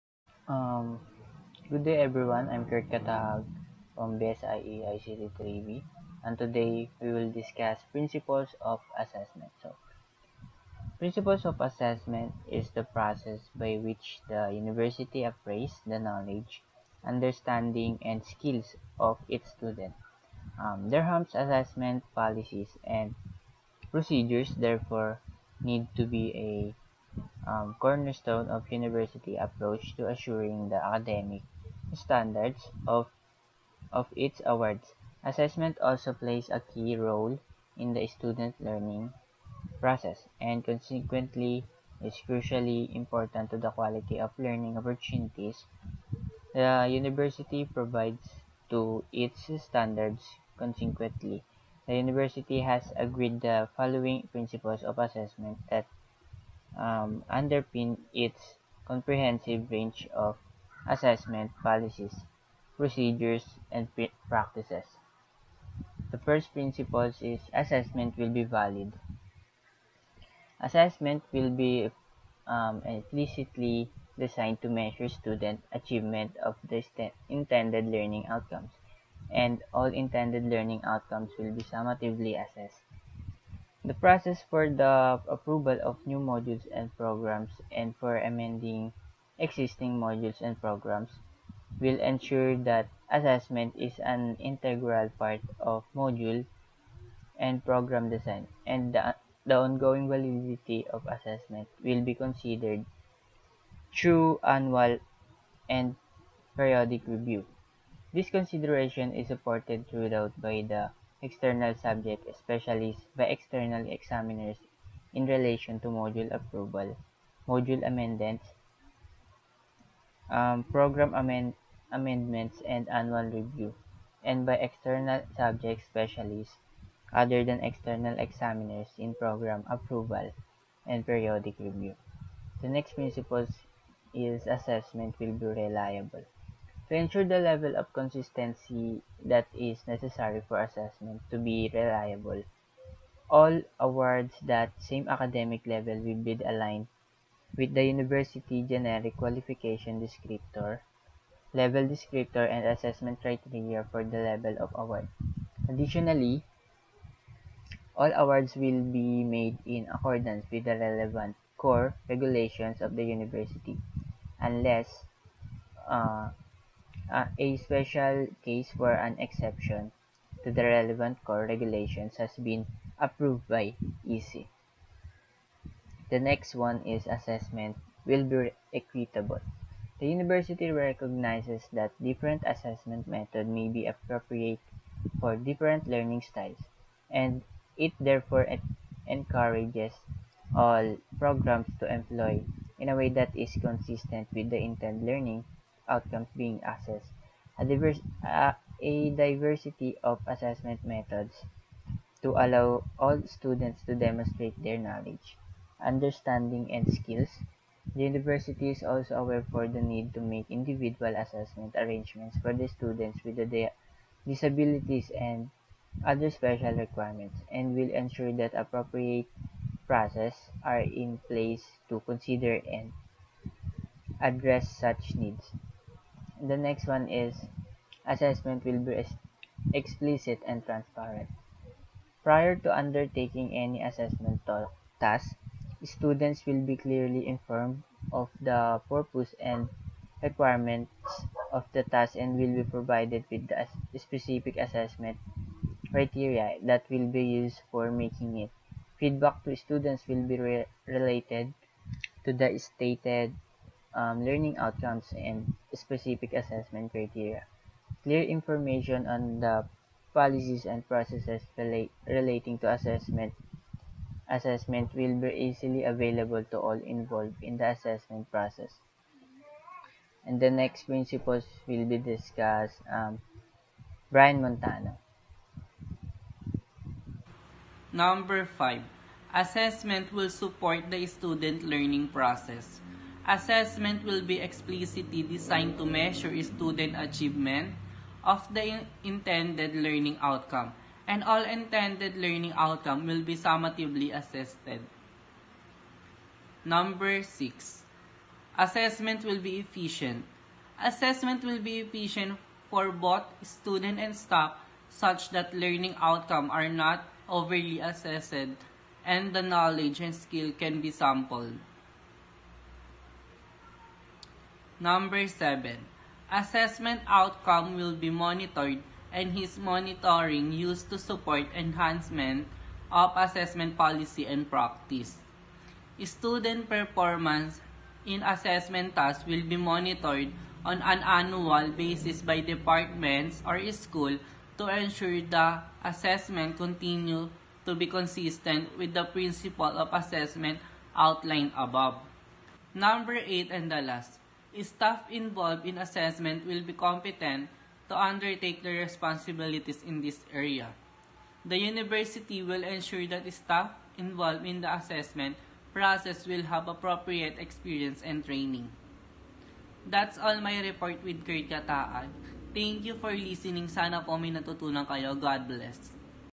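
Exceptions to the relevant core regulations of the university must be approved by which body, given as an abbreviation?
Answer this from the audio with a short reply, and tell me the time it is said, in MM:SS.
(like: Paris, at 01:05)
EC, at 02:54.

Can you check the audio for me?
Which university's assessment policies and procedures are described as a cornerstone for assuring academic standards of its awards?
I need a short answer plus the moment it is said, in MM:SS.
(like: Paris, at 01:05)
Durham, at 00:20.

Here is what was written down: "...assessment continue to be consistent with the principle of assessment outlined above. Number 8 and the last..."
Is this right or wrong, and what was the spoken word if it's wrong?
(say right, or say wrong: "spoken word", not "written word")
right.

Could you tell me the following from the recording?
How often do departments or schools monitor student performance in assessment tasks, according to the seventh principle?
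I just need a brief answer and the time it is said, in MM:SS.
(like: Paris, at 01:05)
annual basis, at 05:31.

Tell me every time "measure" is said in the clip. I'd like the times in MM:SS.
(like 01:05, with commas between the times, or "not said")
01:14, 04:45.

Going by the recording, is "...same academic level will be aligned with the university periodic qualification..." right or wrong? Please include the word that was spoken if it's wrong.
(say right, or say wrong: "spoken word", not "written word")
wrong: "generic", not "periodic".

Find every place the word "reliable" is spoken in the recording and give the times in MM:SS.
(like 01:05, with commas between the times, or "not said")
02:15, 02:21.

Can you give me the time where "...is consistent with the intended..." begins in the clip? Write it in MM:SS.
03:13.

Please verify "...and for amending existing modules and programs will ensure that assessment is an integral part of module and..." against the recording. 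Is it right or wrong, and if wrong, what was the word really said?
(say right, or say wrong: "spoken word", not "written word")
right.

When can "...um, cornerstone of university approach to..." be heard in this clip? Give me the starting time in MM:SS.
00:27.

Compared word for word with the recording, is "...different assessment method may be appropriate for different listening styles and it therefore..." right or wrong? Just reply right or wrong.
wrong.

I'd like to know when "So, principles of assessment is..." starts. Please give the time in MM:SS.
00:09.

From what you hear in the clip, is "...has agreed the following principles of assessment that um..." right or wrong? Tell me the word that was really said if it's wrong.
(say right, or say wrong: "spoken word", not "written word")
right.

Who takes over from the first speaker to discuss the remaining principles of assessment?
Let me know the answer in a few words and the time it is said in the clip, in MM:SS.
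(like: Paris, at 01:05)
Bryan Montano, at 04:34.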